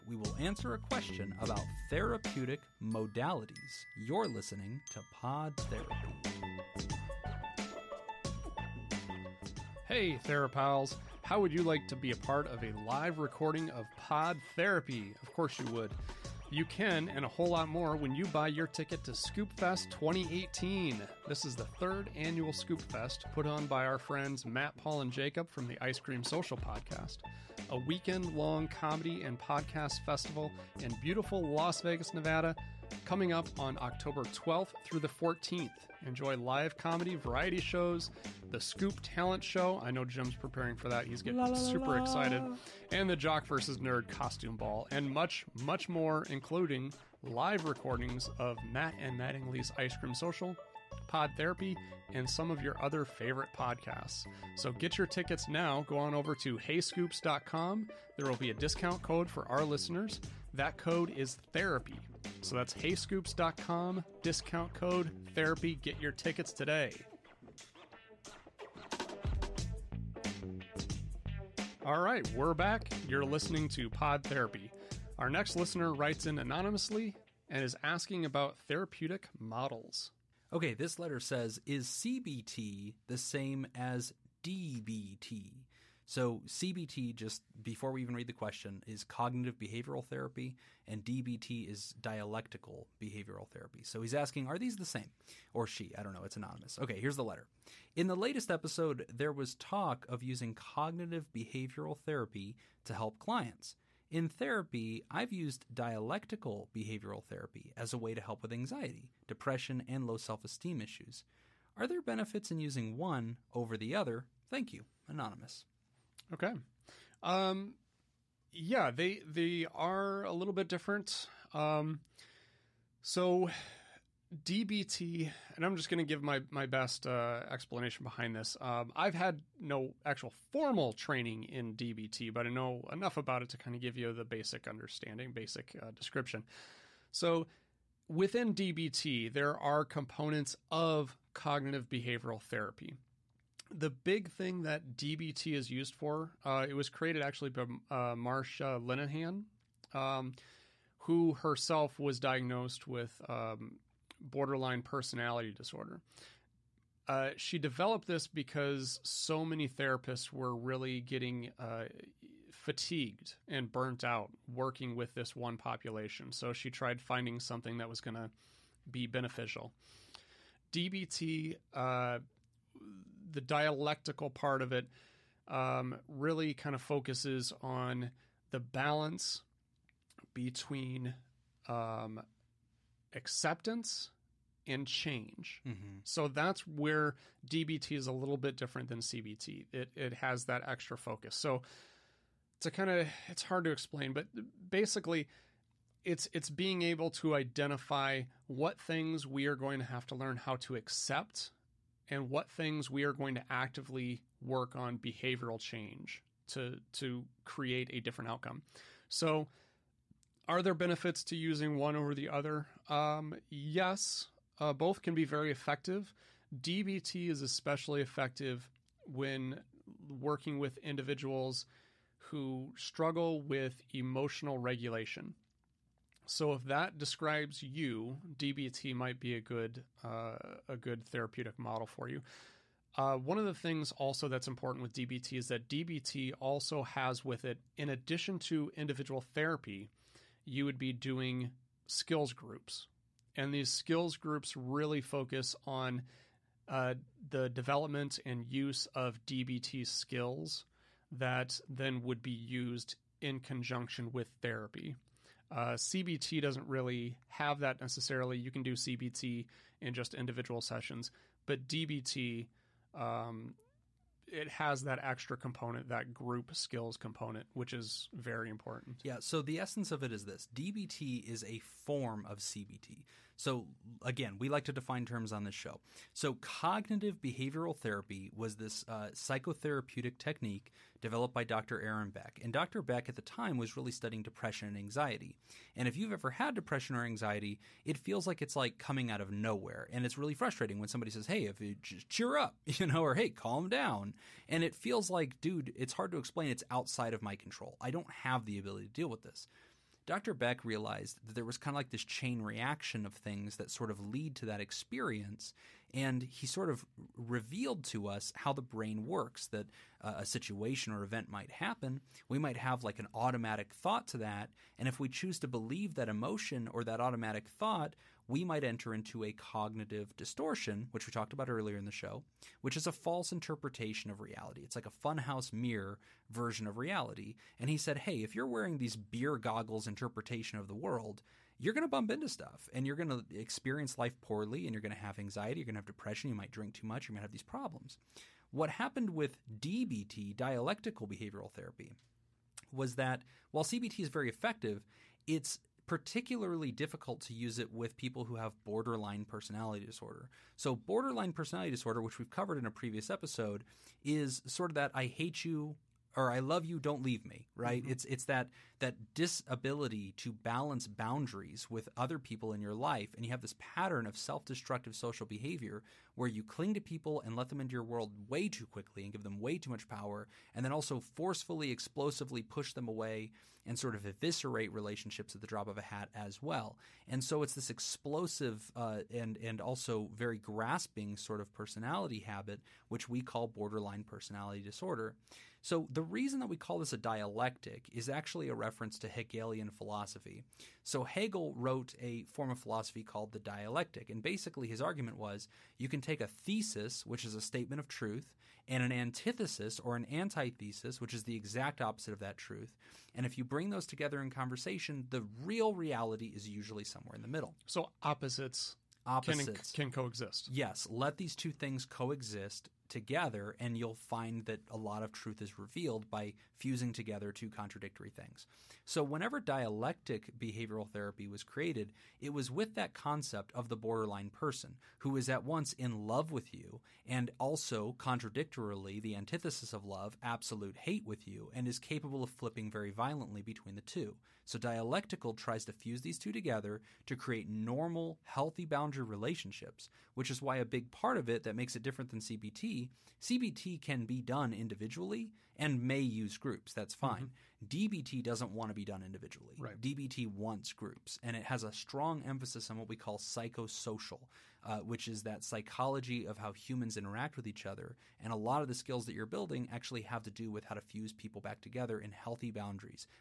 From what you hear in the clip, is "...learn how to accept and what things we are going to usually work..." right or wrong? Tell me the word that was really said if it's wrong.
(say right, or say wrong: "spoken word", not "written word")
wrong: "actively", not "usually".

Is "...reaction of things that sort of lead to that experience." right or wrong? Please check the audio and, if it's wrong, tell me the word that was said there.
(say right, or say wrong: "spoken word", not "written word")
right.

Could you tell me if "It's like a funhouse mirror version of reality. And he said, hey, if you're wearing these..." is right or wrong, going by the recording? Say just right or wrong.
right.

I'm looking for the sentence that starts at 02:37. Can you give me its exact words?
Uh, she developed this because so many therapists were really getting uh, fatigued and burnt out working with this one population.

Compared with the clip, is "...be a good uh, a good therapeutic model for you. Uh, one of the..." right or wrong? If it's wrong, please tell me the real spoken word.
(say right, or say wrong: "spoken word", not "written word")
right.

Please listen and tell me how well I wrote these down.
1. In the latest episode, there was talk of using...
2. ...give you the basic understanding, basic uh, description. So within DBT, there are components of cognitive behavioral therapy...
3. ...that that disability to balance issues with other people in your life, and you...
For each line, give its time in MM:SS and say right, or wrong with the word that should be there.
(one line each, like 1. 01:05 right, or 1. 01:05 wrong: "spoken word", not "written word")
1. 01:37 right
2. 02:13 right
3. 05:58 wrong: "boundaries", not "issues".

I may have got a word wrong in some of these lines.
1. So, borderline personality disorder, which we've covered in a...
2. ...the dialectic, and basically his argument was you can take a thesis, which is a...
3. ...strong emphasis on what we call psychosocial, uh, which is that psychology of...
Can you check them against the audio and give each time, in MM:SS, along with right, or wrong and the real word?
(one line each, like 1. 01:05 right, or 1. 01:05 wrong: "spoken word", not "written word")
1. 05:50 right
2. 06:33 right
3. 07:31 right.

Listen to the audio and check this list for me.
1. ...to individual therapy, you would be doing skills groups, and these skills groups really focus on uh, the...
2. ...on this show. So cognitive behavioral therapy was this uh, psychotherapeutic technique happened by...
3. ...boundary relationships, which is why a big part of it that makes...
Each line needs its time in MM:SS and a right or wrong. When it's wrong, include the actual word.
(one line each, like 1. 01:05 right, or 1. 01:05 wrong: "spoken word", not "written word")
1. 03:58 right
2. 04:35 wrong: "developed", not "happened"
3. 07:18 right.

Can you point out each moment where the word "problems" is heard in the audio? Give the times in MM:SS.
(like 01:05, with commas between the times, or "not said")
05:37.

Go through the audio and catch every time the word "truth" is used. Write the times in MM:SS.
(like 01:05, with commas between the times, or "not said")
06:37, 06:42, 06:55.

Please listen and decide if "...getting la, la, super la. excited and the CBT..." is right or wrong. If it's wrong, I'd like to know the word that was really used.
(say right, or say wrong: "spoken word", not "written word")
wrong: "Jock", not "CBT".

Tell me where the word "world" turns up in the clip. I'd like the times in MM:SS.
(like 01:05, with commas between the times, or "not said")
05:30, 06:07.